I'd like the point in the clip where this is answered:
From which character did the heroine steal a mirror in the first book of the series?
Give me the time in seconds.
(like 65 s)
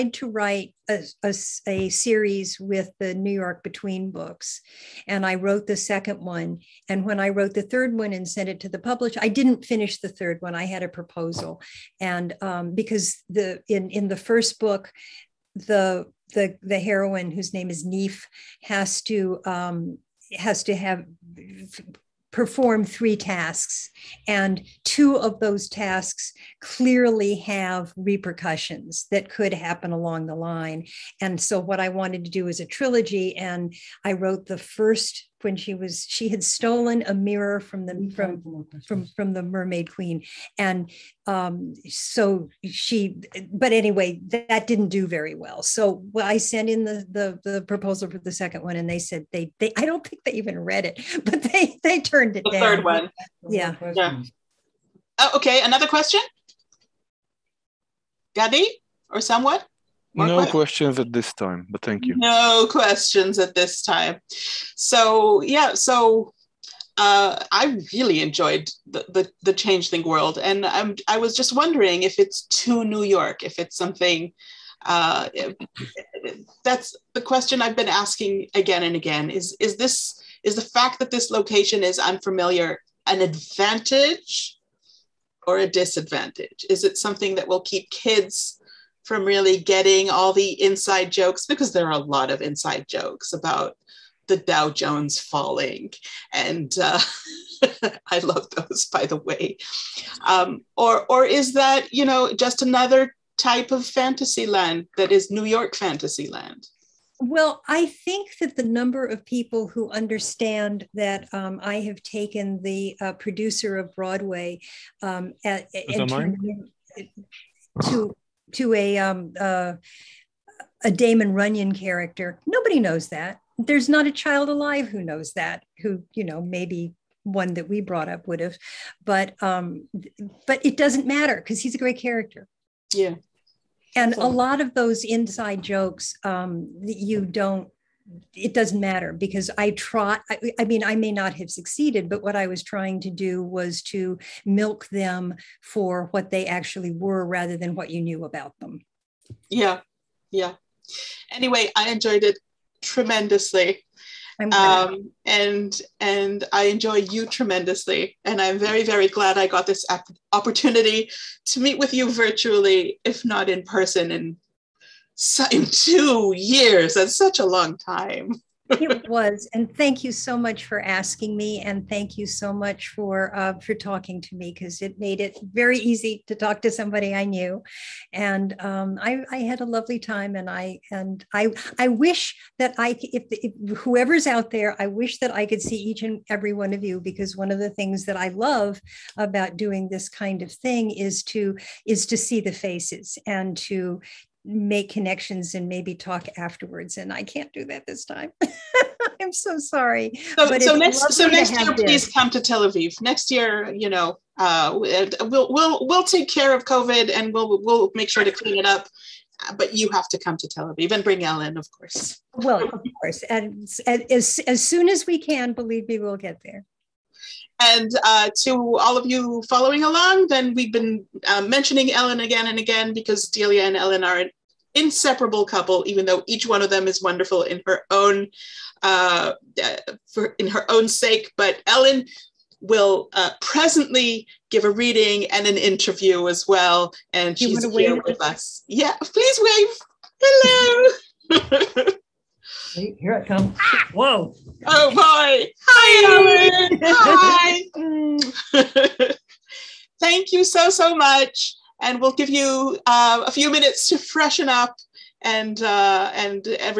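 39 s.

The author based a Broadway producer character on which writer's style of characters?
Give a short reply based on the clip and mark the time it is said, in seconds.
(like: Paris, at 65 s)
Damon Runyon, at 120 s.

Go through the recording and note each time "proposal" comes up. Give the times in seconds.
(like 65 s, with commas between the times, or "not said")
10 s, 47 s.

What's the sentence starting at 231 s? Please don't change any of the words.
But Ellen will uh, presently give a reading and an interview as well, and she's here with us.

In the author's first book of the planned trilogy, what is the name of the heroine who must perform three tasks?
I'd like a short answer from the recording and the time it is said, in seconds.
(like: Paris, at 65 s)
Neef, at 17 s.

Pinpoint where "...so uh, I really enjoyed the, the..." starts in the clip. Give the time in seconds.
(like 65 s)
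65 s.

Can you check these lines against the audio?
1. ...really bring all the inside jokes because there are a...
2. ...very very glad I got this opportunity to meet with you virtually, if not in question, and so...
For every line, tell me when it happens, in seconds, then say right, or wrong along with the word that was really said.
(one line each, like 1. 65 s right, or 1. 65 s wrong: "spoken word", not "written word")
1. 89 s wrong: "getting", not "bring"
2. 158 s wrong: "person", not "question".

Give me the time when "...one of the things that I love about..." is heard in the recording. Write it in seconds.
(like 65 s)
187 s.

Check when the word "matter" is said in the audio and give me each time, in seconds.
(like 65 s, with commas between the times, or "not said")
131 s, 138 s.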